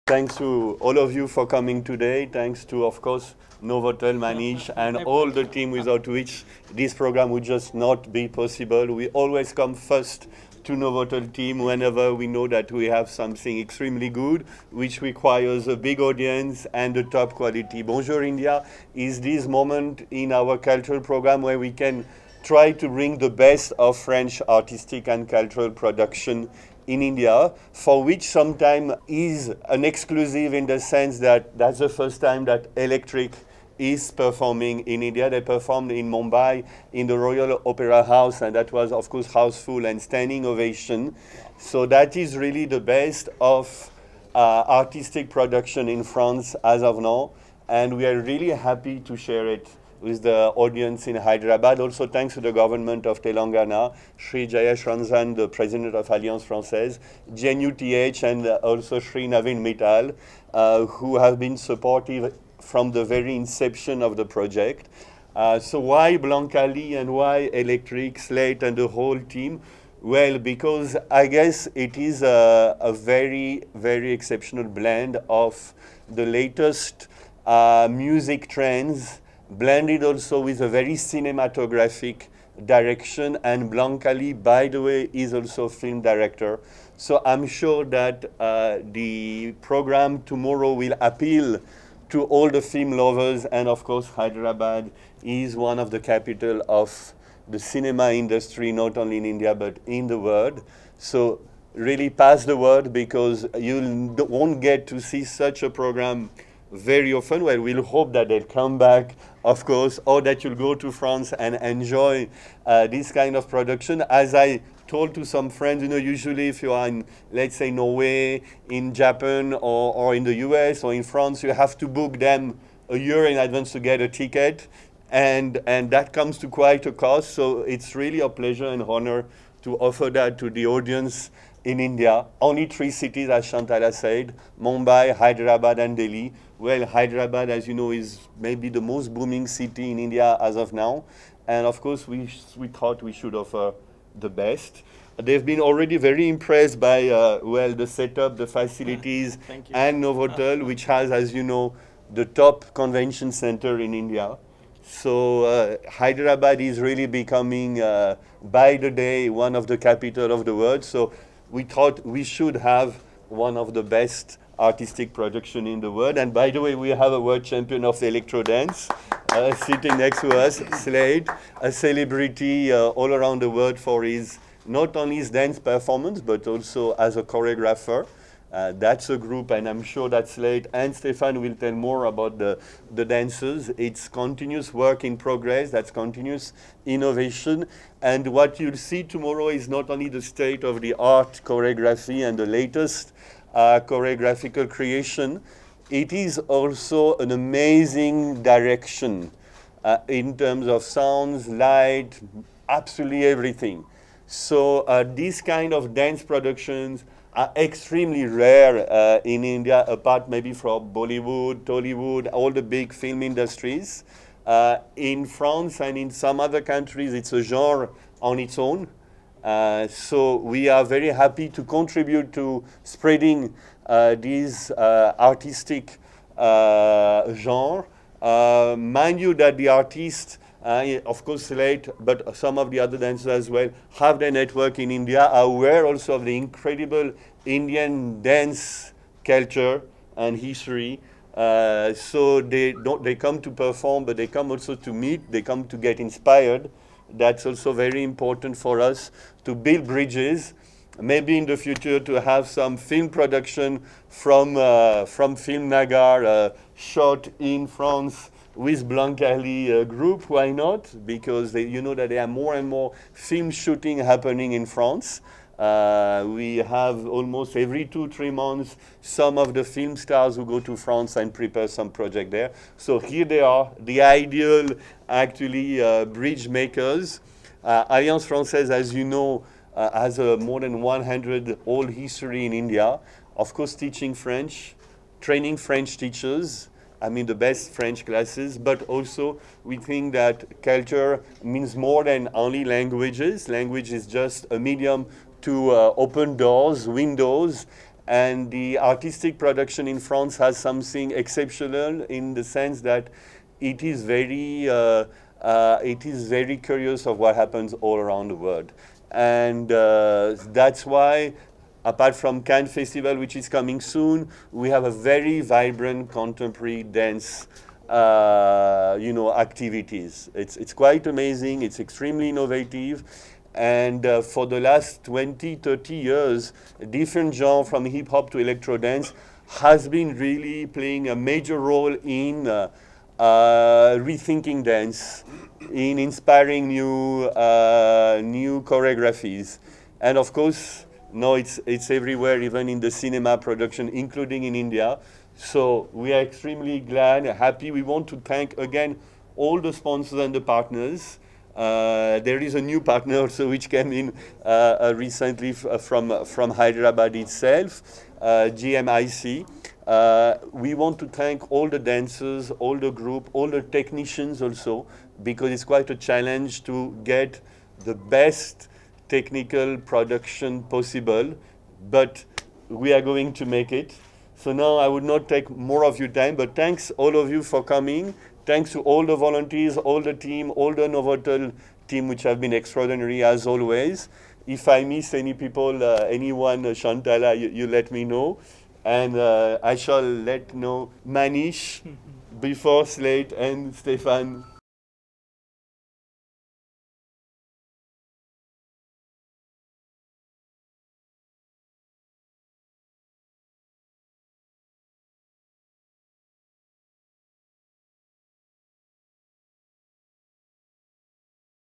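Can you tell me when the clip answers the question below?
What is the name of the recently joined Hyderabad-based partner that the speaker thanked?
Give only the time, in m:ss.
5:58.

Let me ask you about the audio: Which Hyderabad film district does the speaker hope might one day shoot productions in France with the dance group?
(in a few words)
Film Nagar.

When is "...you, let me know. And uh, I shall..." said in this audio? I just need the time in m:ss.
6:27.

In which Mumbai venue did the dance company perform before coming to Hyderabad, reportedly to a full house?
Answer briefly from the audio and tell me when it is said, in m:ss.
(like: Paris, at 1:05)
Royal Opera House, at 0:37.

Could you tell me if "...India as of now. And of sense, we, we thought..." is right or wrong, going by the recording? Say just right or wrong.
wrong.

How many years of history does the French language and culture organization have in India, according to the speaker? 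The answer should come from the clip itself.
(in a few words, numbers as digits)
100.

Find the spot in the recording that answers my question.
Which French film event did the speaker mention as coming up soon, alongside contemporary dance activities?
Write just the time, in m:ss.
5:12.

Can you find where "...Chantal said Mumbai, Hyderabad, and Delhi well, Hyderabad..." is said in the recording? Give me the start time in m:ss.
2:13.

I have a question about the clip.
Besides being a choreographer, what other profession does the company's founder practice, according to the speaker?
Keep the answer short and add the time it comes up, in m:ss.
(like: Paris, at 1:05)
film director, at 1:25.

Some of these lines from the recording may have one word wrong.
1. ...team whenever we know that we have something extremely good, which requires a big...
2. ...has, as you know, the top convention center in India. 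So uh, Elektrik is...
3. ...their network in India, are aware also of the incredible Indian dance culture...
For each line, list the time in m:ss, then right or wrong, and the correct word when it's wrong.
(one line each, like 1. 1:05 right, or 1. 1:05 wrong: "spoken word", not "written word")
1. 0:11 right
2. 2:30 wrong: "Hyderabad", not "Elektrik"
3. 3:54 right.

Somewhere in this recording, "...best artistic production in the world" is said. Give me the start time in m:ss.
2:43.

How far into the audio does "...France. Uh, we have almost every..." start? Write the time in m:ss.
4:24.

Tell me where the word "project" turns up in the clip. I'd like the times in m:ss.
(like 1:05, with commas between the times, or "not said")
1:04, 4:31.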